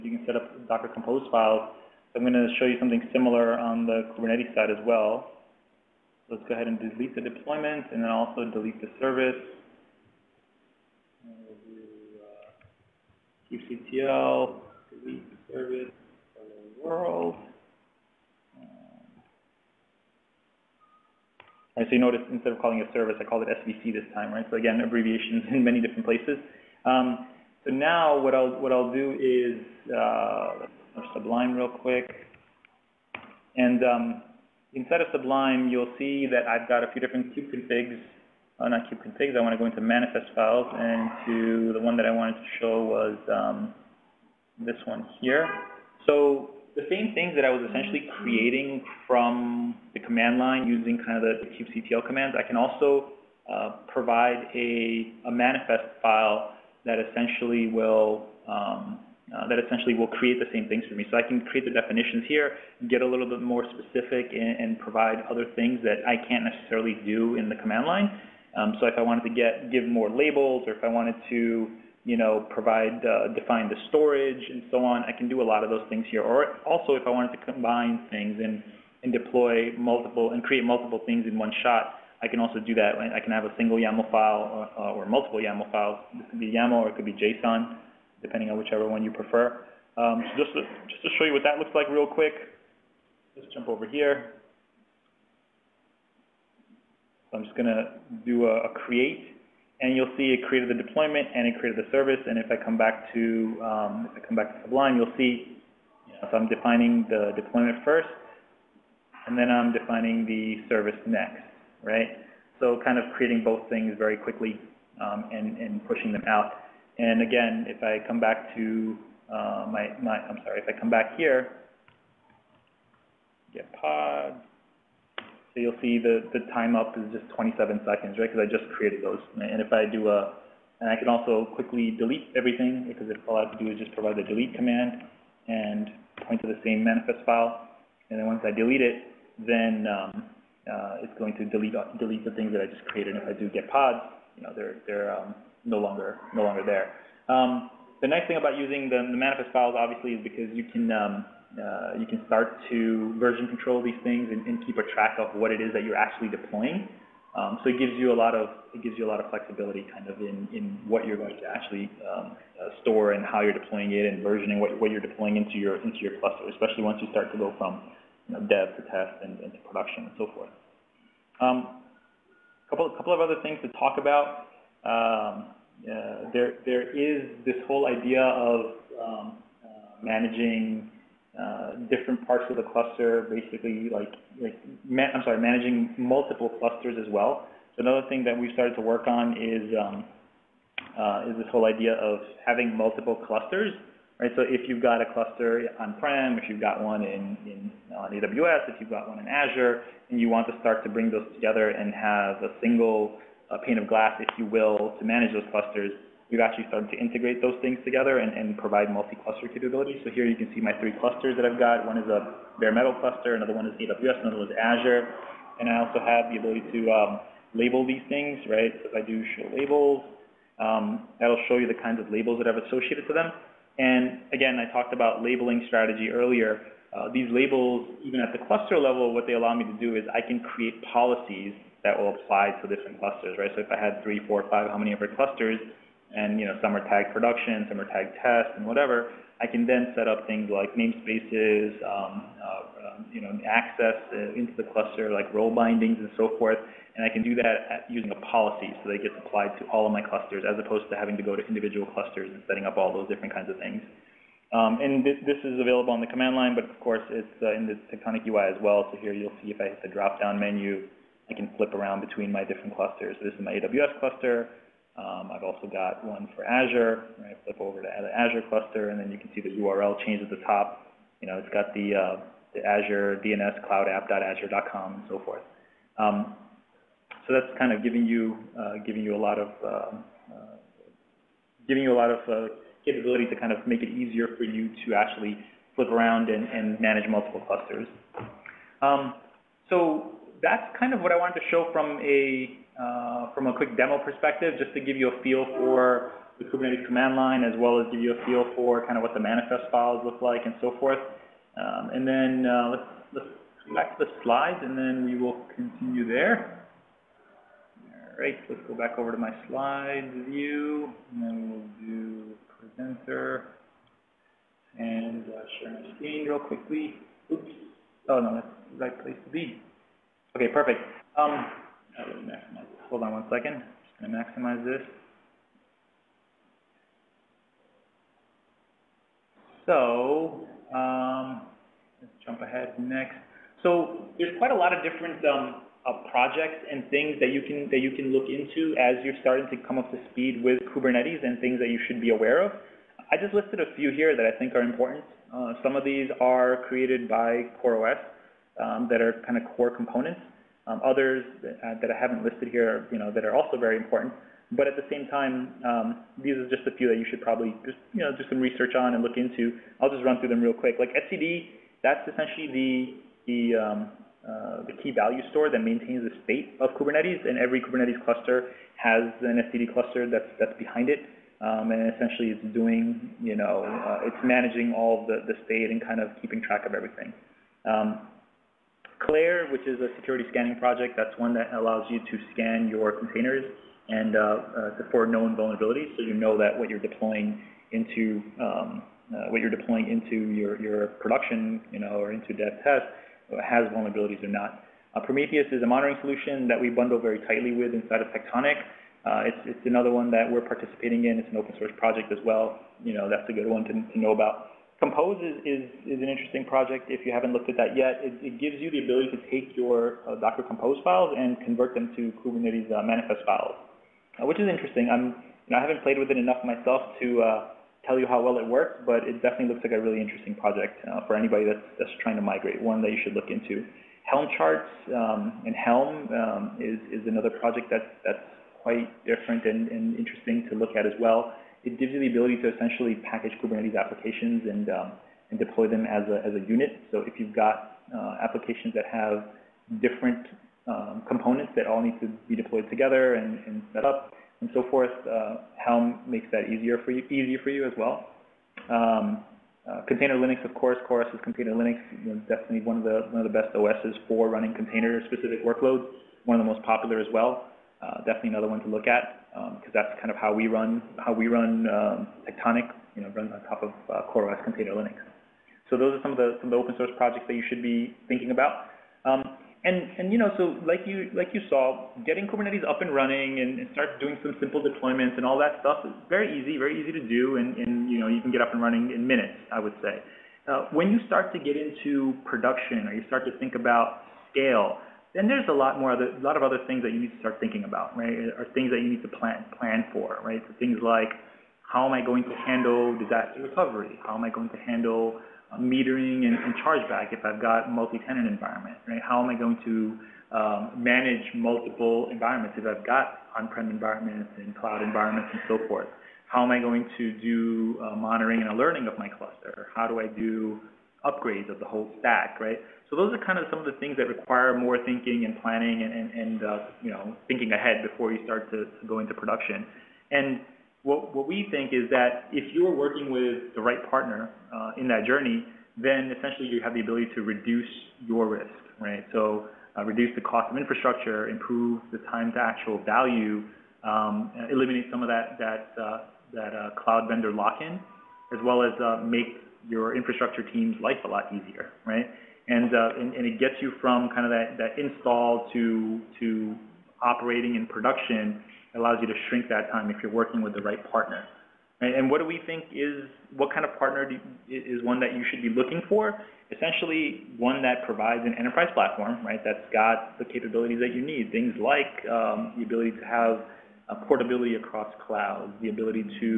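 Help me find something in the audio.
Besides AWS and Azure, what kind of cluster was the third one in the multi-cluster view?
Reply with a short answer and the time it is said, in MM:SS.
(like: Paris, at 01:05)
bare metal, at 03:32.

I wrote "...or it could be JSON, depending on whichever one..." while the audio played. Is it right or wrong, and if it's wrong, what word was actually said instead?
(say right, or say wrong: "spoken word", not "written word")
right.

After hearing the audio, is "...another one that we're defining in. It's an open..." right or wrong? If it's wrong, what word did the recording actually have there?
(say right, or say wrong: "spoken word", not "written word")
wrong: "participating", not "defining".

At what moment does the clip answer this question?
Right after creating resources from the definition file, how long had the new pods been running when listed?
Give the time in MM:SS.
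02:07.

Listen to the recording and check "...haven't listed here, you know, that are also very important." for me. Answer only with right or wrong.
right.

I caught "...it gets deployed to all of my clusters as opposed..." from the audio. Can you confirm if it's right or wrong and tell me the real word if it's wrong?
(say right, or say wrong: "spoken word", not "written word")
wrong: "applied", not "deployed".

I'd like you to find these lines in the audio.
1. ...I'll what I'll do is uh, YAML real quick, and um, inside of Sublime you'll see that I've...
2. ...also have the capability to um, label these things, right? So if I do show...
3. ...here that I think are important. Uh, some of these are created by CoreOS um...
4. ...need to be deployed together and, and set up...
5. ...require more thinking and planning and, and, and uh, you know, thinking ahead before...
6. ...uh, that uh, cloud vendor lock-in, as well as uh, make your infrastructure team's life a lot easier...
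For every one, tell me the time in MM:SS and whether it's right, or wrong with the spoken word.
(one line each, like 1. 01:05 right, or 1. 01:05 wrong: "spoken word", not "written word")
1. 00:28 wrong: "Sublime", not "YAML"
2. 03:35 wrong: "ability", not "capability"
3. 05:43 right
4. 07:21 right
5. 08:34 right
6. 08:55 right.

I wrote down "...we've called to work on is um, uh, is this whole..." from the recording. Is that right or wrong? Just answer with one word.
wrong.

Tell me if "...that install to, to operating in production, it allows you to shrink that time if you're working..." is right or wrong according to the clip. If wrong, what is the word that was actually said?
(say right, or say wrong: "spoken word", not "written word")
right.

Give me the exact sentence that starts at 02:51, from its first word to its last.
A um, couple couple of other things to talk about.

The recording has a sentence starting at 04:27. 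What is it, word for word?
I flip over to the Azure cluster, and then you can see the URL change at the top.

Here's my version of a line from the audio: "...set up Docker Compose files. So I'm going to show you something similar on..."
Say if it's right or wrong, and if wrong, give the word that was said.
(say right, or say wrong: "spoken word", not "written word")
right.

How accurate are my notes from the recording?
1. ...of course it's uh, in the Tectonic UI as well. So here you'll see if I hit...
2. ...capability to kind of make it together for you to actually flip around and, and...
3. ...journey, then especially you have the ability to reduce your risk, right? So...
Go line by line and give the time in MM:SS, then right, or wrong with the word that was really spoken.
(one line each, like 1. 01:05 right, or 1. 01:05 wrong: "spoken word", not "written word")
1. 04:16 right
2. 04:42 wrong: "easier", not "together"
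3. 08:45 wrong: "essentially", not "especially".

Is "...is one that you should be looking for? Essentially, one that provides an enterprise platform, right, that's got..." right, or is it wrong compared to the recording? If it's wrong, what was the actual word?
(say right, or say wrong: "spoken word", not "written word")
right.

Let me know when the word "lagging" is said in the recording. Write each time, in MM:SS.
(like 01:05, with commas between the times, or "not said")
not said.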